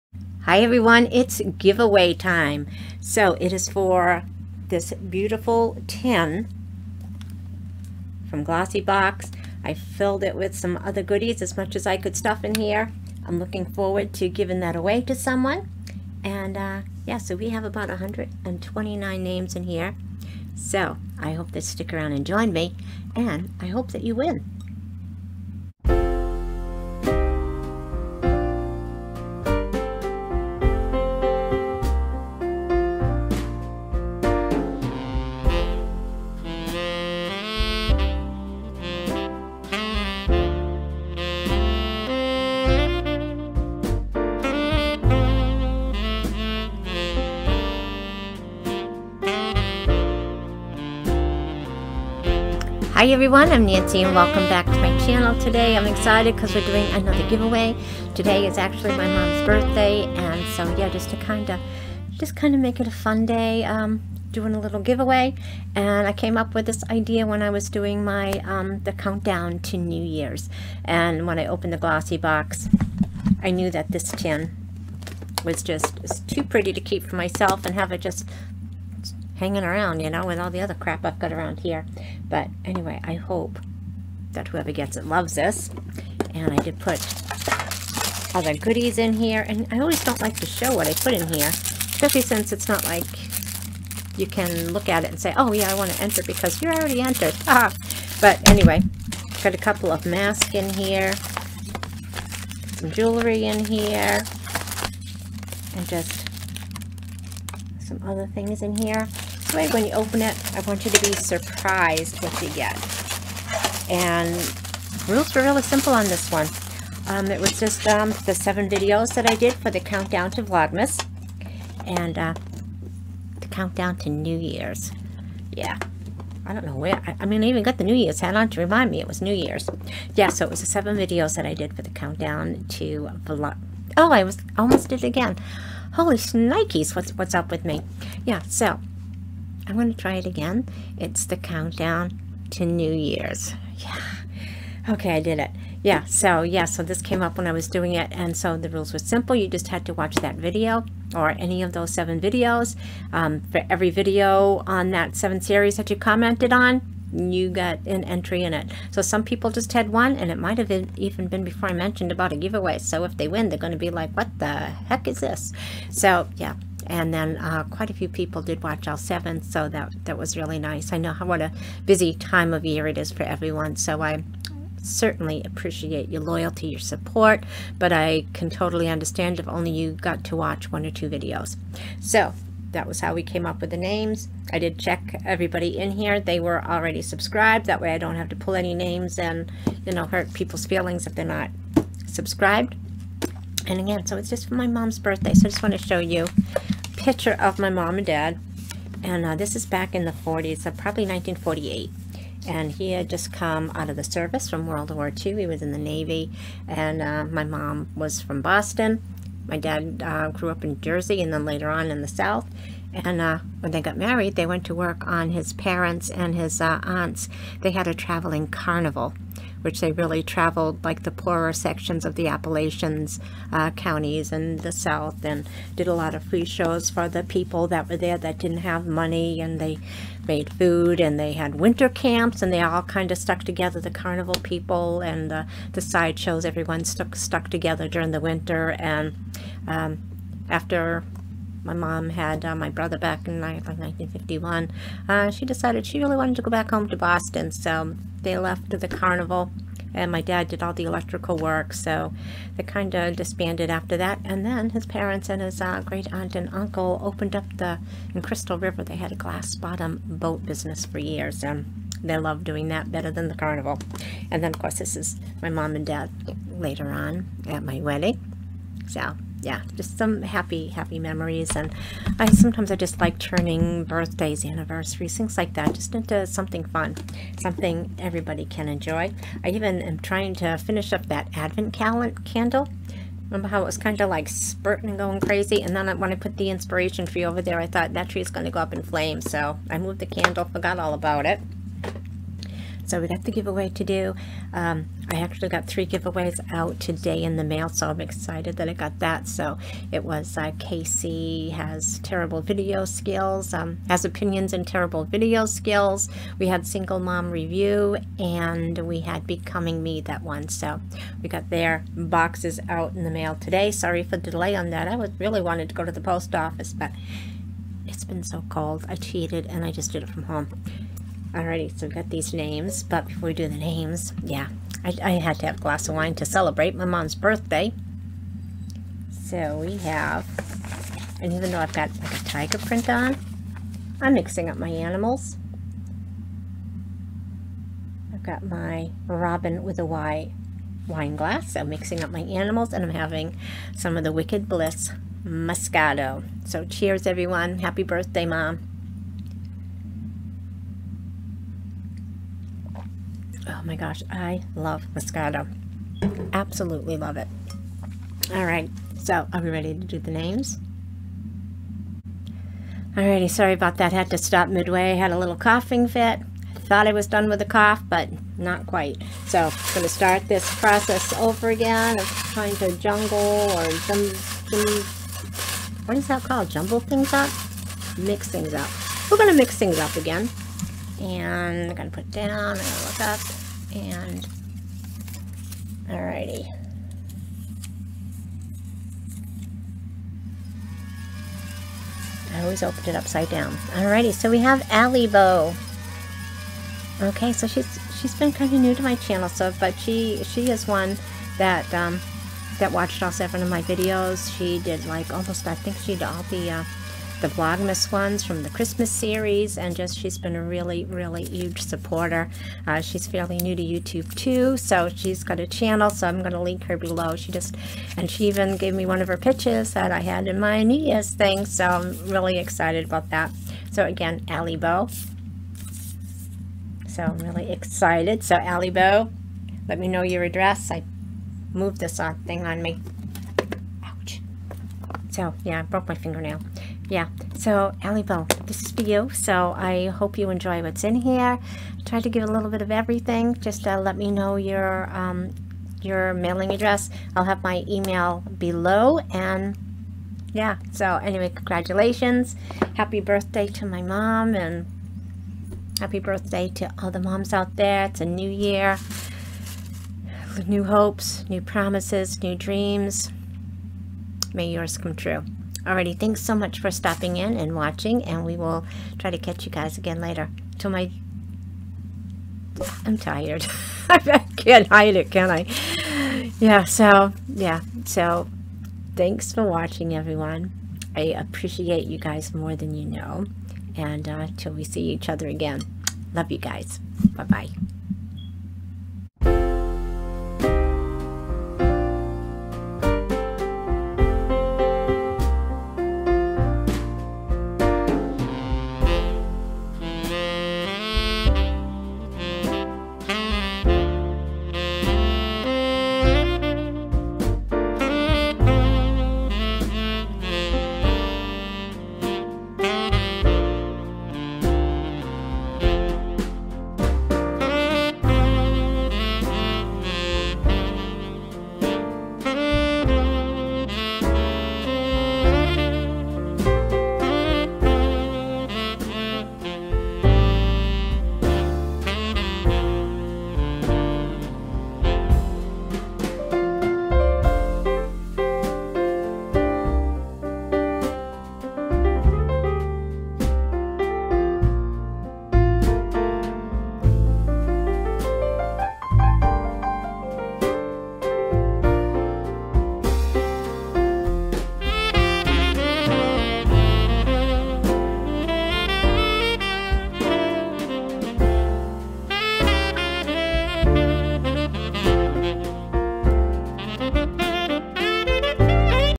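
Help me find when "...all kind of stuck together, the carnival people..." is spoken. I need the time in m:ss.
3:52.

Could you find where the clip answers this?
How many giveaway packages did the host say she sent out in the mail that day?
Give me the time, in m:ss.
4:55.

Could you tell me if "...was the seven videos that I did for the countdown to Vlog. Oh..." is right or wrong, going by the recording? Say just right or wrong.
right.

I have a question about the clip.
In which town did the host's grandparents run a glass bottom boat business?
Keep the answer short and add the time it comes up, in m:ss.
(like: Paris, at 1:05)
Crystal River, at 4:18.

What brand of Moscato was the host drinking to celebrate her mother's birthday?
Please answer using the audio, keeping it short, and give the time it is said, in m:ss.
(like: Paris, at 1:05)
Wicked Bliss, at 5:44.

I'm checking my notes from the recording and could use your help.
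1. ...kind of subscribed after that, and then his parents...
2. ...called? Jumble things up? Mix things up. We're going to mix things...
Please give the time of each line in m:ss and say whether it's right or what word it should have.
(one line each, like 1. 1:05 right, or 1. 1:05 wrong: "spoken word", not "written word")
1. 4:12 wrong: "disbanded", not "subscribed"
2. 6:16 right.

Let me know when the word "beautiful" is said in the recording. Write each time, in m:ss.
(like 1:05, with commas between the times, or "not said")
0:04.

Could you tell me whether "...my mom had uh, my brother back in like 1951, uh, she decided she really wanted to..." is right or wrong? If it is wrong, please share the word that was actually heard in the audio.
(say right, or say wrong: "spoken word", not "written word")
right.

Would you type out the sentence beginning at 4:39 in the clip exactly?
I even am trying to finish up that advent candle.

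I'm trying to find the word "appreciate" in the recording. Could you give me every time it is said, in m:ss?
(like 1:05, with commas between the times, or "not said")
2:55, 8:01.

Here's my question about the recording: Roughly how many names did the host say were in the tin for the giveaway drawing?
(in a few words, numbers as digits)
129.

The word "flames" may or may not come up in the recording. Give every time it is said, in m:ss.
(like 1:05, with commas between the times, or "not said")
4:48.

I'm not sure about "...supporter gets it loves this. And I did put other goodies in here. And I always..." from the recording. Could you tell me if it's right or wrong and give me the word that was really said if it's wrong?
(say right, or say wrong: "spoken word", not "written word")
wrong: "whoever", not "supporter".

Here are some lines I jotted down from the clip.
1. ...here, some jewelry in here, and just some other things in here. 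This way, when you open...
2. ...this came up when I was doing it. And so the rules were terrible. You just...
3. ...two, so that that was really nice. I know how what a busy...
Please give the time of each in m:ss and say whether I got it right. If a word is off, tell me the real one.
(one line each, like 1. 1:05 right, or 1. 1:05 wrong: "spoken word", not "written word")
1. 1:40 right
2. 2:26 wrong: "simple", not "terrible"
3. 2:48 wrong: "seven", not "two".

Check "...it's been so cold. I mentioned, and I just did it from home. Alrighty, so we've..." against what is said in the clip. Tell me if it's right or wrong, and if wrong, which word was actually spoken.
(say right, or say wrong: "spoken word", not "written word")
wrong: "cheated", not "mentioned".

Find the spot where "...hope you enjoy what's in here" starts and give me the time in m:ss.
7:19.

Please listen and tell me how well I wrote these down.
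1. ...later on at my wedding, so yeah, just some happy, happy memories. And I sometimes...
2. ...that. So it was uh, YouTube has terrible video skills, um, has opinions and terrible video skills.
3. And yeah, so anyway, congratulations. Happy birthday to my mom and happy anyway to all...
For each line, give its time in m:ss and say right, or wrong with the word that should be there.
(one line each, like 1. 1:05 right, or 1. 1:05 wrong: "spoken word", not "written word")
1. 4:26 right
2. 4:58 wrong: "Casey", not "YouTube"
3. 7:29 wrong: "birthday", not "anyway".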